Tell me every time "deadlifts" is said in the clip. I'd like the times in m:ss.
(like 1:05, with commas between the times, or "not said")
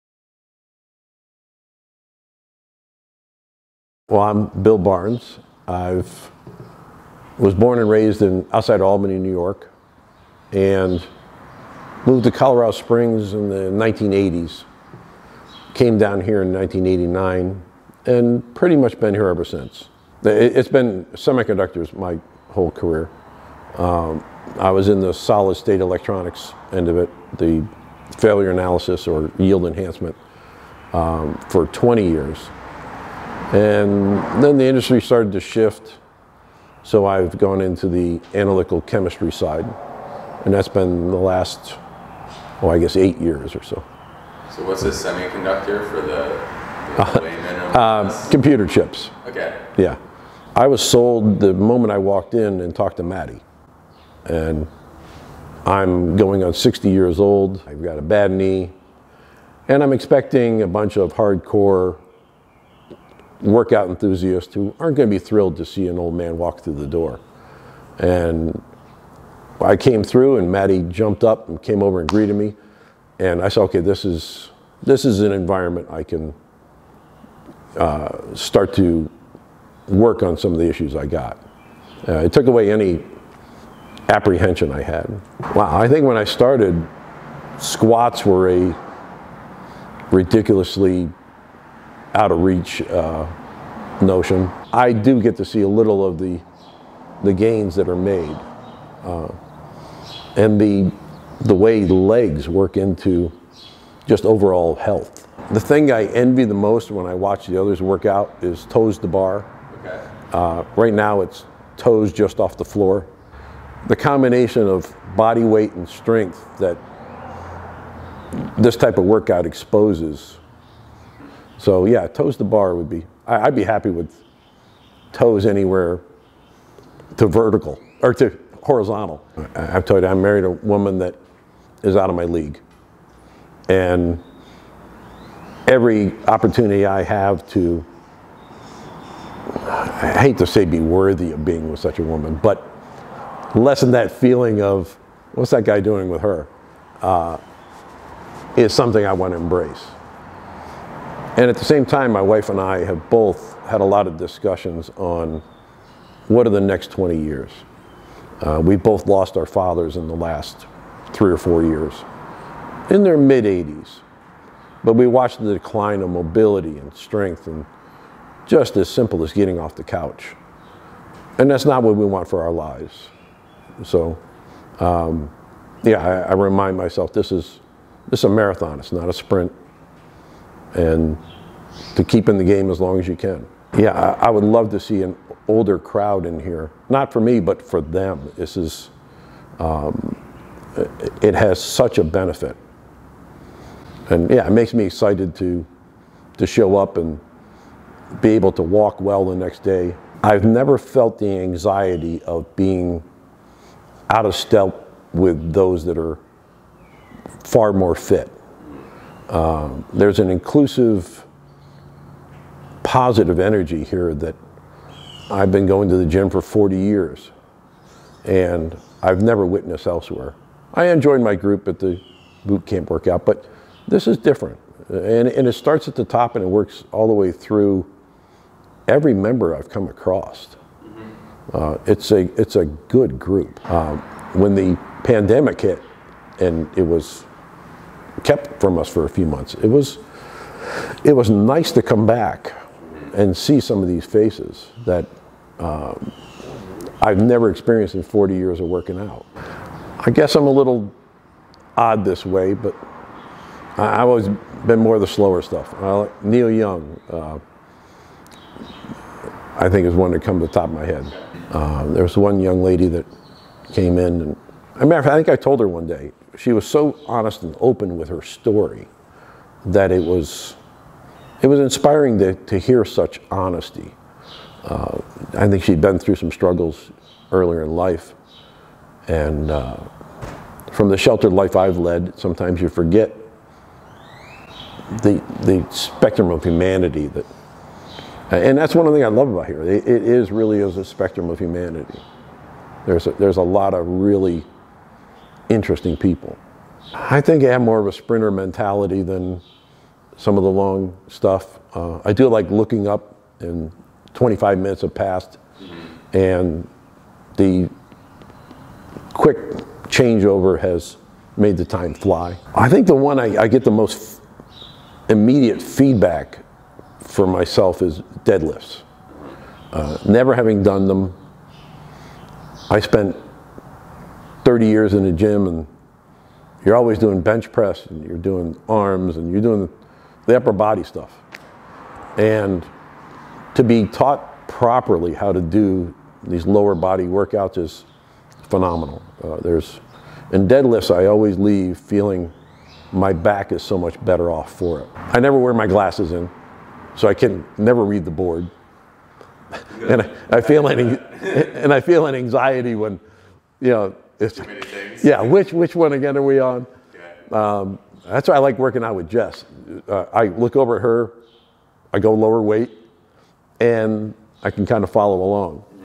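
5:18, 5:40.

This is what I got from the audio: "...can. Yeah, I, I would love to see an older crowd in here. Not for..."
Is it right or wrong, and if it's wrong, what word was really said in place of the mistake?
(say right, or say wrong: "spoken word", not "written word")
right.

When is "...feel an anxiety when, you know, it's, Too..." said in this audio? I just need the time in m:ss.
5:51.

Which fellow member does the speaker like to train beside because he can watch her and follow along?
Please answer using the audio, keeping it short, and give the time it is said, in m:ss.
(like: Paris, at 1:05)
Jess, at 5:59.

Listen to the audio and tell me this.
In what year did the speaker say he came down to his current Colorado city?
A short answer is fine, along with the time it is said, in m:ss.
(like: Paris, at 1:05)
1989, at 0:16.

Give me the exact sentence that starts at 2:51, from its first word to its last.
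And that's not what we want for our lives.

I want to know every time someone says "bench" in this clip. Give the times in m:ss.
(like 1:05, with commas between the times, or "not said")
5:27.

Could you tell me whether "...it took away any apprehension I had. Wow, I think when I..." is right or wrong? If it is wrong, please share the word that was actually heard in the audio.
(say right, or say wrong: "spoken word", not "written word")
right.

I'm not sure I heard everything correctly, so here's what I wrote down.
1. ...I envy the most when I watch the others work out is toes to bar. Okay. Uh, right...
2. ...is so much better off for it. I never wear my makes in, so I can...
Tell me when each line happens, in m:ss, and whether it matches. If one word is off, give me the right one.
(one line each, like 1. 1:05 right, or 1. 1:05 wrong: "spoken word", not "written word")
1. 1:45 right
2. 5:43 wrong: "glasses", not "makes".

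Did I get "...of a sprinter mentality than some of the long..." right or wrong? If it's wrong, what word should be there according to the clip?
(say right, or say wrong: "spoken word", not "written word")
right.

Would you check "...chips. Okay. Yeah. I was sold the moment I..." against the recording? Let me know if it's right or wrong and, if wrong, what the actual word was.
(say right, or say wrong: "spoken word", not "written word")
right.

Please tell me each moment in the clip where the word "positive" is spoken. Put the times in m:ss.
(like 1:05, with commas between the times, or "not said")
3:32.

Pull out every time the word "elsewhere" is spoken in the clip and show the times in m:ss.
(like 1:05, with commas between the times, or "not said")
3:39.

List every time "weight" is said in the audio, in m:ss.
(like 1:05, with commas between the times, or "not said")
1:55, 6:02.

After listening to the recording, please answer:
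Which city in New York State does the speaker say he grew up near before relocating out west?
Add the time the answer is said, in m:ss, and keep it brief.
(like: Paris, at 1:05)
Albany, at 0:08.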